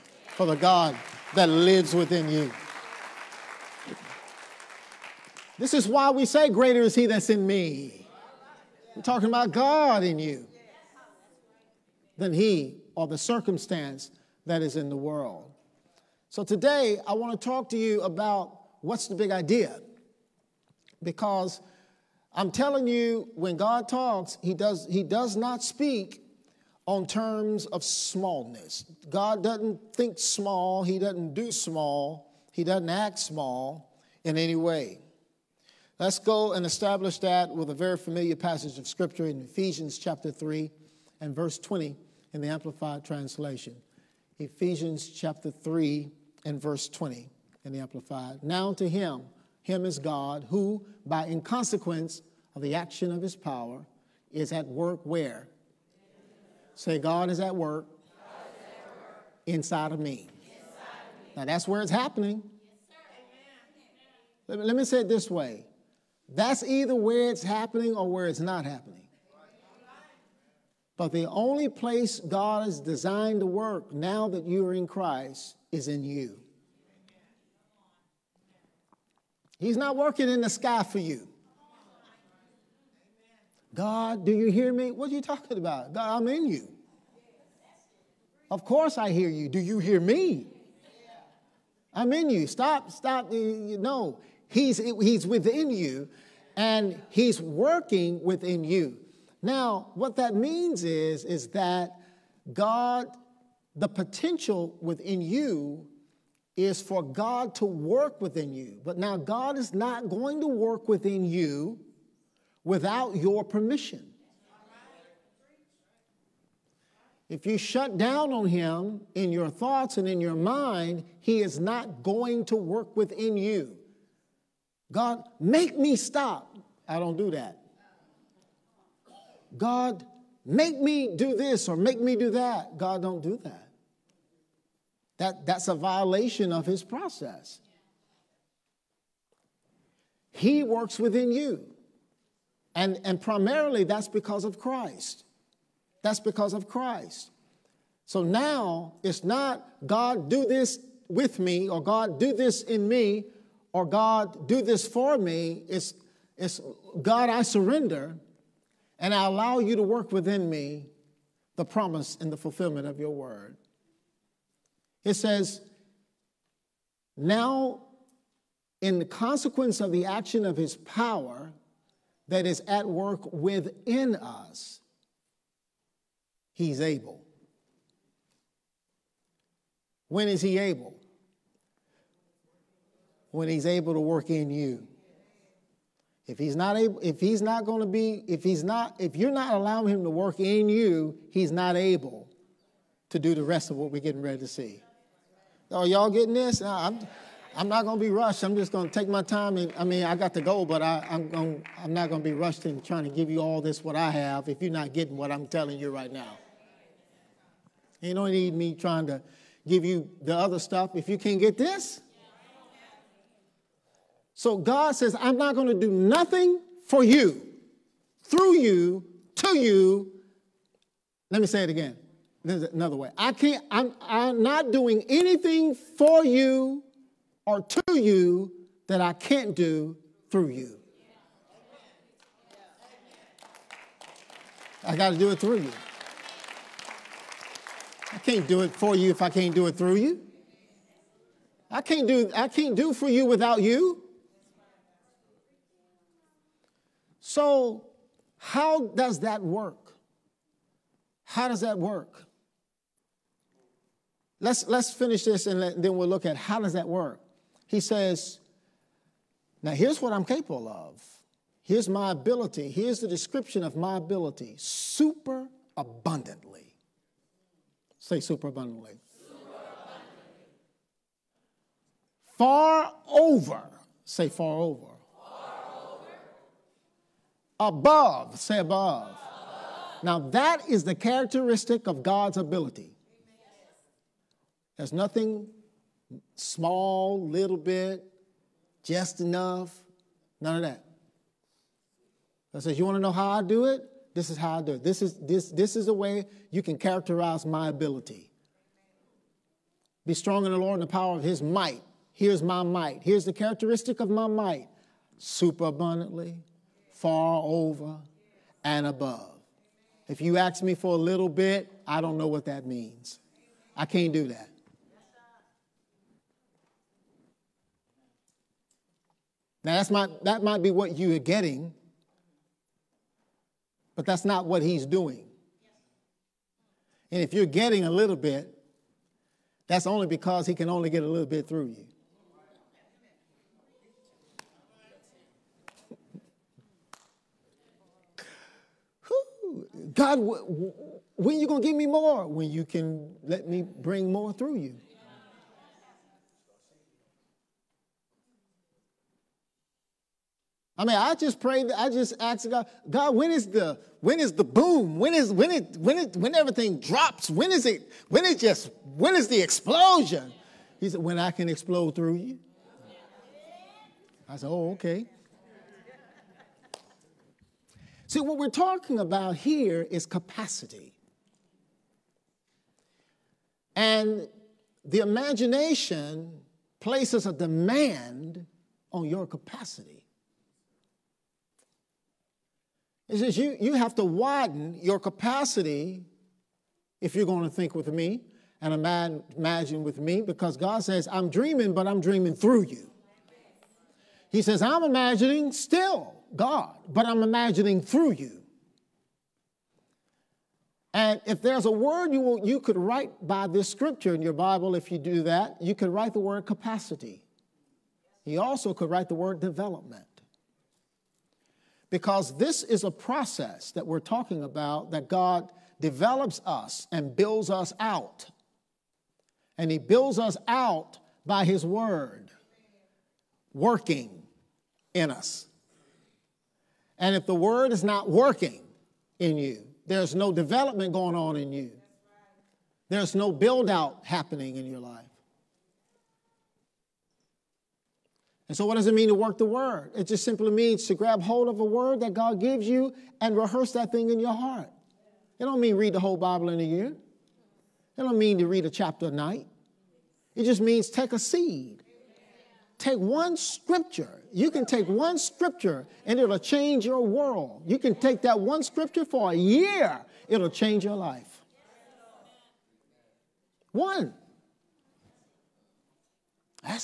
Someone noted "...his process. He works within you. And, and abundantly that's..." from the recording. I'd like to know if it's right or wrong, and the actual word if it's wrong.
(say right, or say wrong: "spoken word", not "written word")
wrong: "primarily", not "abundantly".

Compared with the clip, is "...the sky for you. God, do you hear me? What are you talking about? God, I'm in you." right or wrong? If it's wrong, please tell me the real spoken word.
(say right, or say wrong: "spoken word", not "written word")
right.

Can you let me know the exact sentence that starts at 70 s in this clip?
But the only place God has designed to work now that you are in Christ is in you.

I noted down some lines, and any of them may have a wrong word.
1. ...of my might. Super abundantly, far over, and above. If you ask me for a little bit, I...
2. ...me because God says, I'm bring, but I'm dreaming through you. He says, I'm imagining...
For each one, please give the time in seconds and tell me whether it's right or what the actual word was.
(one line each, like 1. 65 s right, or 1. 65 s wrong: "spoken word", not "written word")
1. 303 s right
2. 389 s wrong: "dreaming", not "bring".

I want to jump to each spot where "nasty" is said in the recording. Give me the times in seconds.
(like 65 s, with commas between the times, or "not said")
not said.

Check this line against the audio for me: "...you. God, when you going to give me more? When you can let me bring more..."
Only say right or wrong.
right.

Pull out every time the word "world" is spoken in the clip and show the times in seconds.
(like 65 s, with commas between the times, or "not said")
14 s, 457 s.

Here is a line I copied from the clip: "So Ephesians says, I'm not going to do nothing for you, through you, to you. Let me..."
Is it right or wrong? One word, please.
wrong.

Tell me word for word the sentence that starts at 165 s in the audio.
It says, Now, in the consequence of the action of his power that is at work within us, he's able.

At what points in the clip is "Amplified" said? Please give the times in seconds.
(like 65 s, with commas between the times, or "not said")
42 s, 47 s.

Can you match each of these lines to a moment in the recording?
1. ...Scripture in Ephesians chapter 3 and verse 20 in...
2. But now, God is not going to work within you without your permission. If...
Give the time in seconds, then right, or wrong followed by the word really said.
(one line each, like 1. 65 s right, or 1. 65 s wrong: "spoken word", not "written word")
1. 38 s right
2. 108 s right.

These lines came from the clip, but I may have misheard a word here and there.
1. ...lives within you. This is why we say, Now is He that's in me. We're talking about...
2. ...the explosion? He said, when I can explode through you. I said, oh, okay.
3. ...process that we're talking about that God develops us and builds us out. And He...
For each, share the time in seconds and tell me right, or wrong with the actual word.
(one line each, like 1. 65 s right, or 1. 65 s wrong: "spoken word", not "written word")
1. 1 s wrong: "Greater", not "Now"
2. 359 s right
3. 412 s right.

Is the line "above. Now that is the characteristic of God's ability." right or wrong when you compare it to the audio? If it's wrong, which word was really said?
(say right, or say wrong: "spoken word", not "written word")
right.